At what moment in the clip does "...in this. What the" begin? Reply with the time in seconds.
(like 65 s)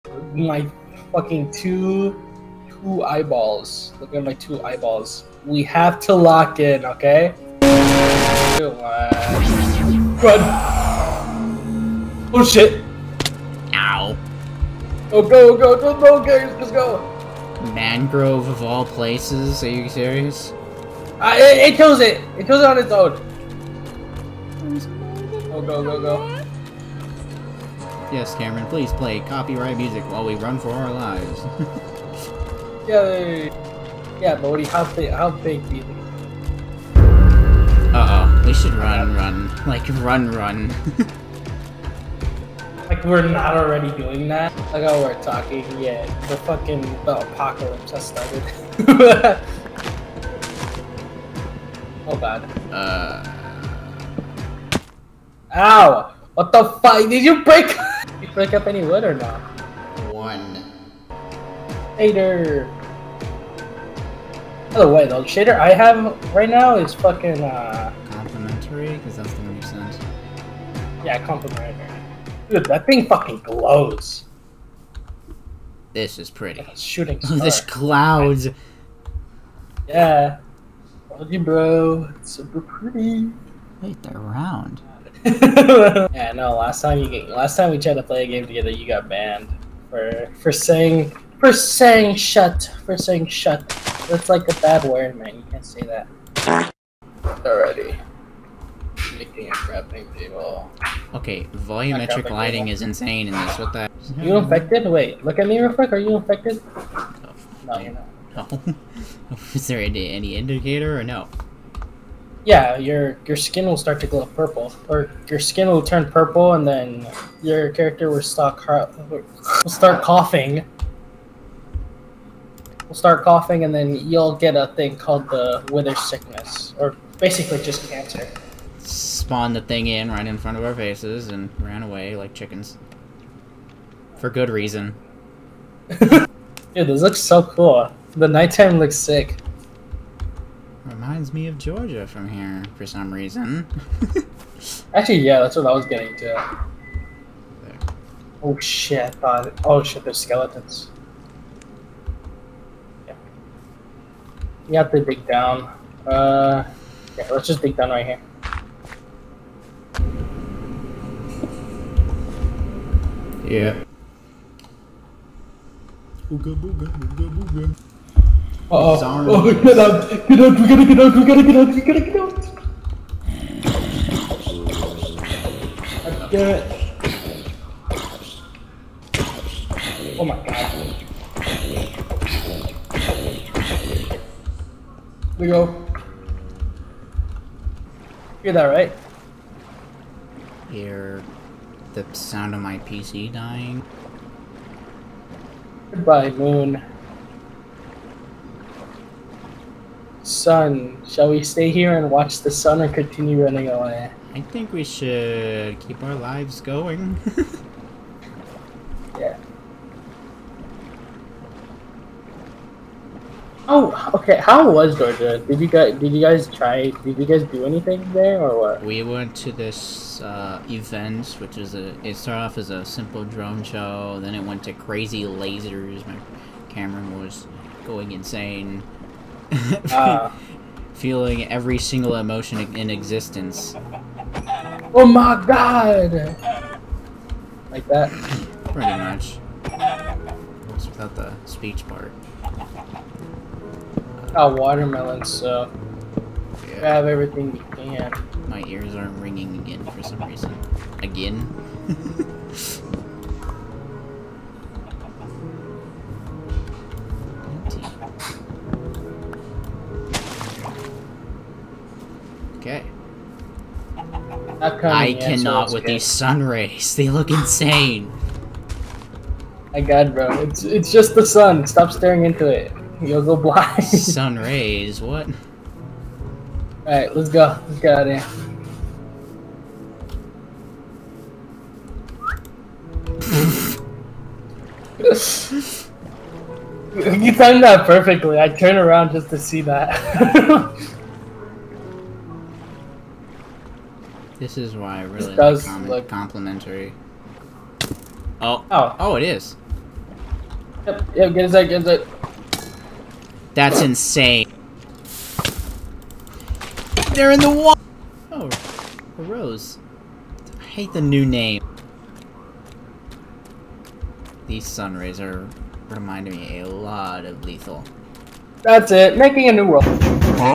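103 s.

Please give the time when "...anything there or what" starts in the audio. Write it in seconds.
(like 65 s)
217 s.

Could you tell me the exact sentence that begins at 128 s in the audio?
Spawned the thing in right in front of our faces and ran away like chickens.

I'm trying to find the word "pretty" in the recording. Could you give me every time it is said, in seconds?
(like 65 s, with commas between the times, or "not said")
76 s, 82 s, 238 s.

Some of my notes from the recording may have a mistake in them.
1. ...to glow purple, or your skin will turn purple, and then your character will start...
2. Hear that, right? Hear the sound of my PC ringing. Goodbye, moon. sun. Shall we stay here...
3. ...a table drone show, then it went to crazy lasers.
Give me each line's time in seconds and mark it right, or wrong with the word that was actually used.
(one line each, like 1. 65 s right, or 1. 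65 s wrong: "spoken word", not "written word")
1. 114 s right
2. 188 s wrong: "dying", not "ringing"
3. 222 s wrong: "simple", not "table".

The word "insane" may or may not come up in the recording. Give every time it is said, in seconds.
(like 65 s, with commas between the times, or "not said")
102 s, 228 s, 267 s, 303 s.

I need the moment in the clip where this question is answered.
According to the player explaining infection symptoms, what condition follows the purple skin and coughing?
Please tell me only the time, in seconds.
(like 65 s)
125 s.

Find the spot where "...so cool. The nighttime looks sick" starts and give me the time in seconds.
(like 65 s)
137 s.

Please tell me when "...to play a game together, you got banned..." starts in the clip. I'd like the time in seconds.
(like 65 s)
87 s.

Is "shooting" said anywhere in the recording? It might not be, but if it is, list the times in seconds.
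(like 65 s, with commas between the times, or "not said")
76 s.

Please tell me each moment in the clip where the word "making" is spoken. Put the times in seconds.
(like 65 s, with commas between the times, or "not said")
99 s, 319 s.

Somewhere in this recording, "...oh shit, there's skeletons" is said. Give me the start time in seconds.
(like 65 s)
149 s.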